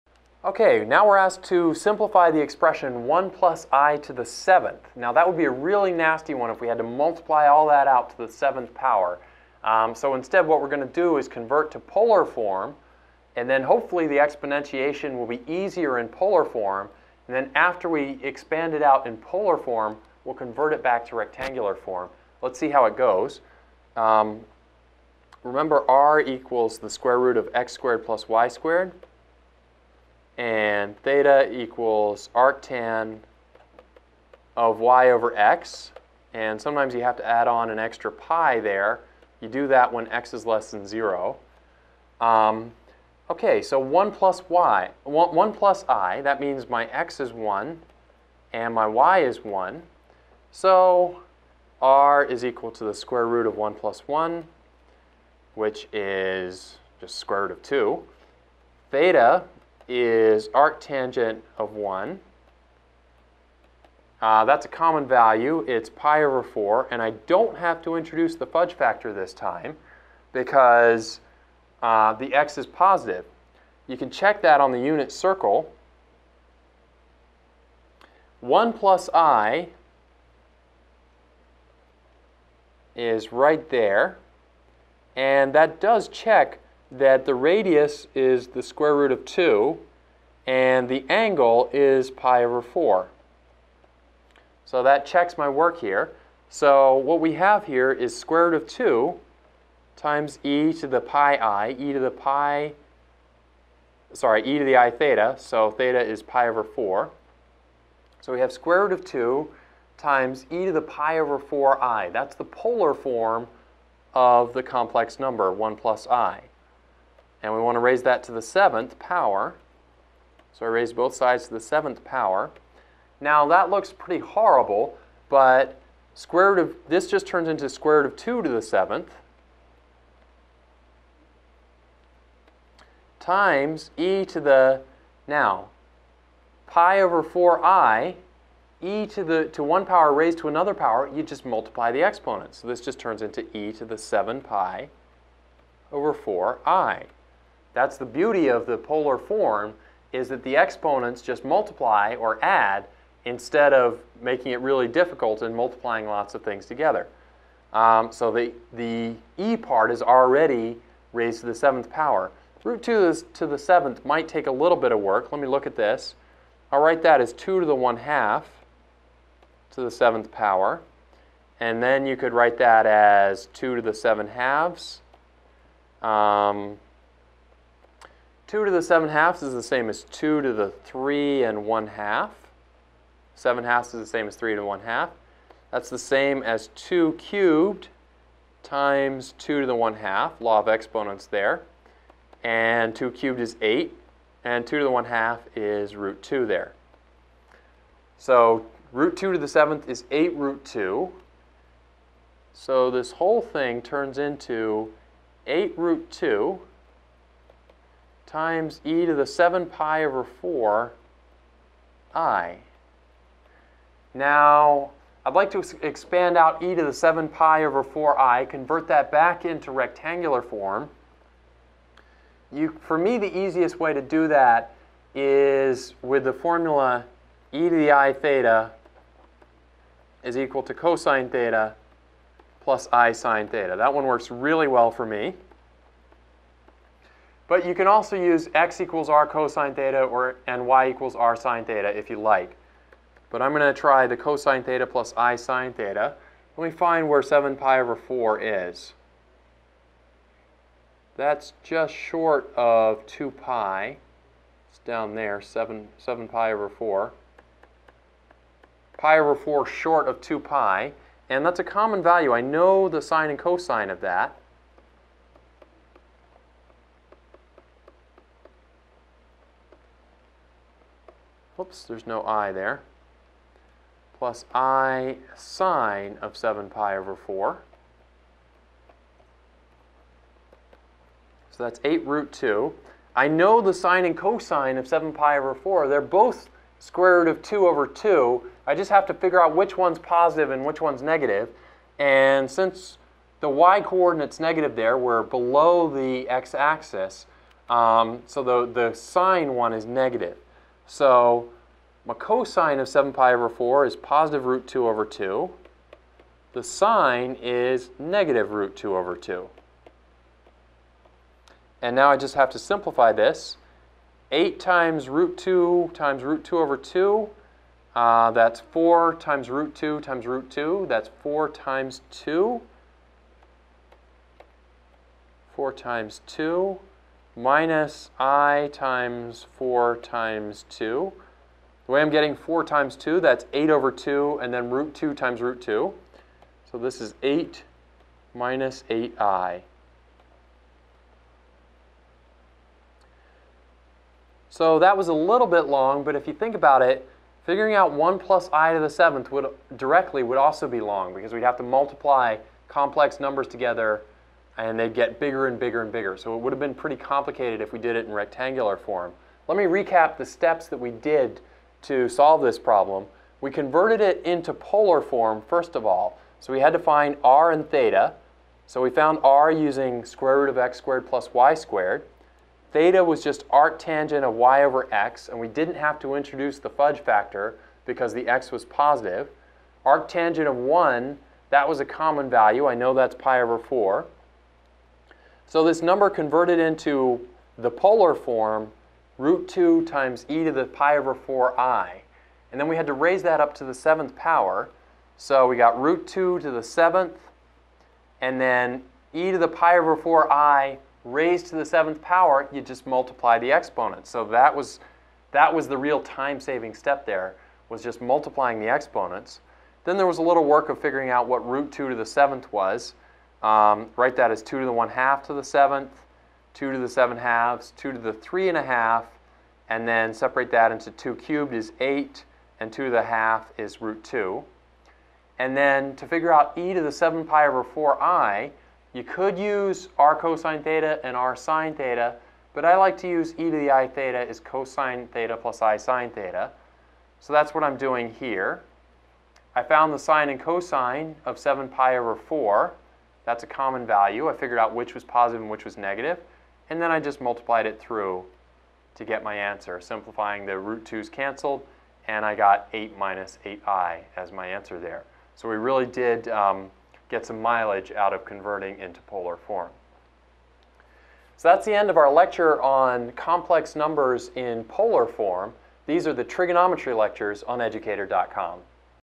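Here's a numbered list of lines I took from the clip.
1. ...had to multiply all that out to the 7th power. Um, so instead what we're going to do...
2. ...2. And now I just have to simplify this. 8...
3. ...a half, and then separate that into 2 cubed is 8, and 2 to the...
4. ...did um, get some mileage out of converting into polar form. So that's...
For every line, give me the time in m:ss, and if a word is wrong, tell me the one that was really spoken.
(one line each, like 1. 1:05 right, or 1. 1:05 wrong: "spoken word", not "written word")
1. 0:06 right
2. 5:09 right
3. 6:58 right
4. 7:35 right.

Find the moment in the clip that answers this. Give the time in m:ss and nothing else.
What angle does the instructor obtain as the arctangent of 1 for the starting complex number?
1:05.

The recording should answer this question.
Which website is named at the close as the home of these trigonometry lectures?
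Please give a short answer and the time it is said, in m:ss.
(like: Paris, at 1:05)
educator.com, at 7:47.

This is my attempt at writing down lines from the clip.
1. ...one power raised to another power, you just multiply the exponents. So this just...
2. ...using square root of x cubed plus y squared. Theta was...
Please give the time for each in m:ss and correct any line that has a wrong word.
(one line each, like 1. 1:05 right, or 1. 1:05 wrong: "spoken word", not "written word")
1. 2:19 right
2. 6:09 wrong: "squared", not "cubed".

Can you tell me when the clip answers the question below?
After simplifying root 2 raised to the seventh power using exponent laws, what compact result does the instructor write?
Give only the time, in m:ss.
3:18.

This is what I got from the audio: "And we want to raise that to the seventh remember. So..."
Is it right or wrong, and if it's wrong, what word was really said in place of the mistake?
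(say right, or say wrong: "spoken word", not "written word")
wrong: "power", not "remember".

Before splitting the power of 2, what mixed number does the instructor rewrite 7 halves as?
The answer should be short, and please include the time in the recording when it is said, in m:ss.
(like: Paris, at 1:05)
3 and 1 half, at 3:00.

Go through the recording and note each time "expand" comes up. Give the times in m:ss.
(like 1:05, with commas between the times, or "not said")
0:18, 3:35.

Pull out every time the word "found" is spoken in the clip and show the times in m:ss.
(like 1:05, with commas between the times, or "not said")
6:08, 7:19.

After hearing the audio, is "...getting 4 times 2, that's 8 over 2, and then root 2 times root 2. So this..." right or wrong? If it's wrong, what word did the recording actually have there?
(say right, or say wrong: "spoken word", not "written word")
right.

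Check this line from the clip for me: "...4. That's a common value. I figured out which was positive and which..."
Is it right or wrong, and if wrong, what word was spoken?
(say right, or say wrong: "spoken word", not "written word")
right.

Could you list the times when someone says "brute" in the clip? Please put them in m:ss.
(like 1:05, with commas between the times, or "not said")
not said.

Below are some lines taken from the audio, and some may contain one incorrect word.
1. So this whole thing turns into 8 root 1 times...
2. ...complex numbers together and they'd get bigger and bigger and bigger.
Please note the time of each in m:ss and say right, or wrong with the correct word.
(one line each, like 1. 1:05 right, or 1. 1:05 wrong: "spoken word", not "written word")
1. 3:22 wrong: "2", not "1"
2. 5:52 right.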